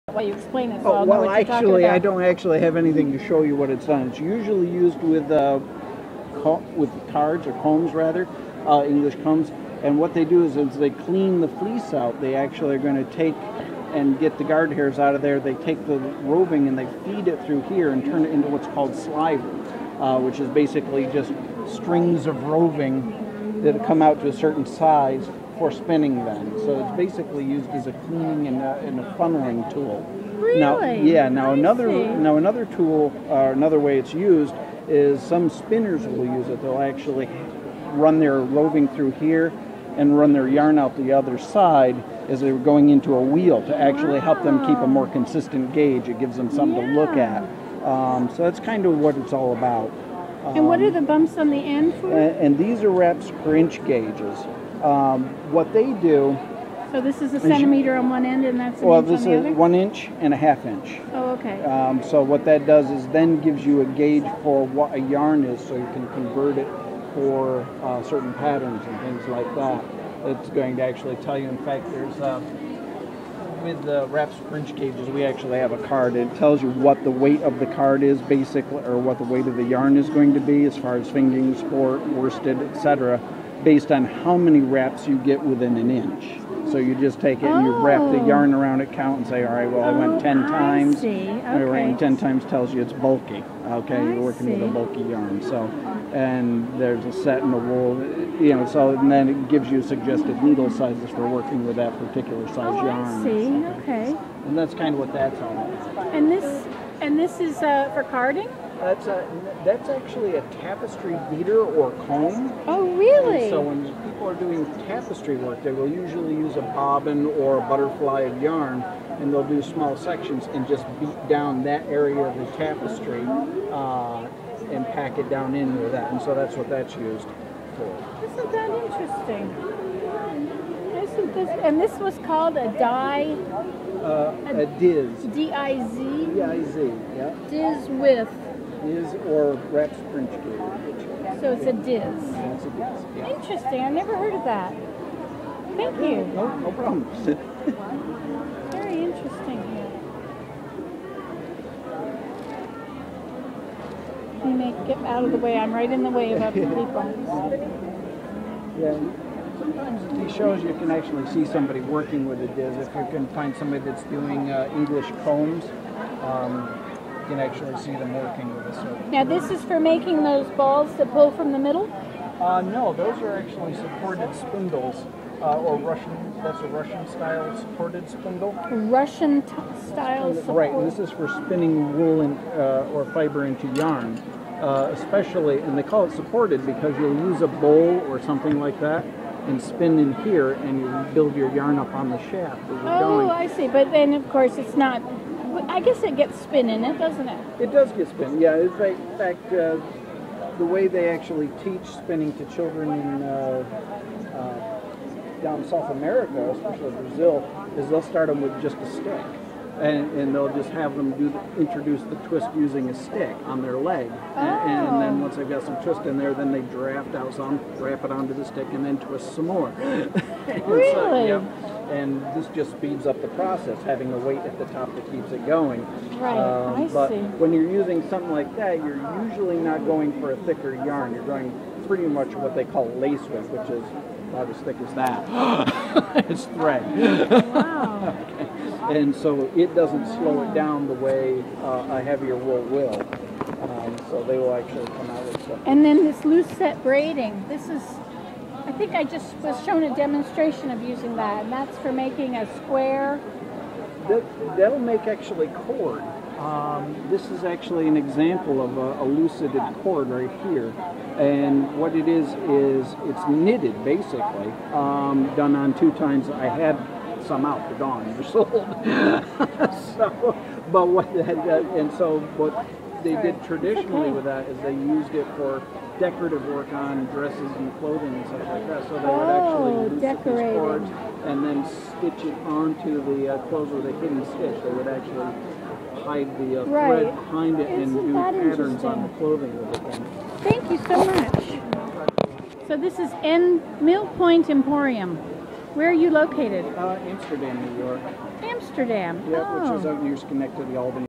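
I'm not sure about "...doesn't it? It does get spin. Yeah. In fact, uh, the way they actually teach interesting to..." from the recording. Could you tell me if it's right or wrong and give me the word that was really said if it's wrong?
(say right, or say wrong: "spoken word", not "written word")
wrong: "spinning", not "interesting".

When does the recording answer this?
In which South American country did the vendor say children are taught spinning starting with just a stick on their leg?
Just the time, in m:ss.
3:26.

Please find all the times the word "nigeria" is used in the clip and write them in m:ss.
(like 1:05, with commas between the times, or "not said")
not said.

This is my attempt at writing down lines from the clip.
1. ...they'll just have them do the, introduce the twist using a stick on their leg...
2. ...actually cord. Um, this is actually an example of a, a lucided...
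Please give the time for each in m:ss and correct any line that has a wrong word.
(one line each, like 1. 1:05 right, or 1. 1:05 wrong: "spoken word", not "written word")
1. 3:30 right
2. 4:15 right.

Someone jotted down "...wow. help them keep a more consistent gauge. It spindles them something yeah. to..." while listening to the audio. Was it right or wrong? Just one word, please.
wrong.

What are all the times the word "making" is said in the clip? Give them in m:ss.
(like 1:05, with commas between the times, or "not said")
2:49, 4:11.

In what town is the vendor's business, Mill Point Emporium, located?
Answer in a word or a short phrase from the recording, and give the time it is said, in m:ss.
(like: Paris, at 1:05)
Amsterdam, New York, at 4:57.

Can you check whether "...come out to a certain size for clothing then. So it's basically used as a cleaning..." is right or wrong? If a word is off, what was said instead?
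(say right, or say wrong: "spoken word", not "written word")
wrong: "spinning", not "clothing".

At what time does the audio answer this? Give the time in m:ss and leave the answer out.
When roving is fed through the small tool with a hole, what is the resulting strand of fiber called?
0:18.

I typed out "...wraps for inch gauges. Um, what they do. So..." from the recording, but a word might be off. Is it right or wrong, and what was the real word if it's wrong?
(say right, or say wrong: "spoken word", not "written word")
right.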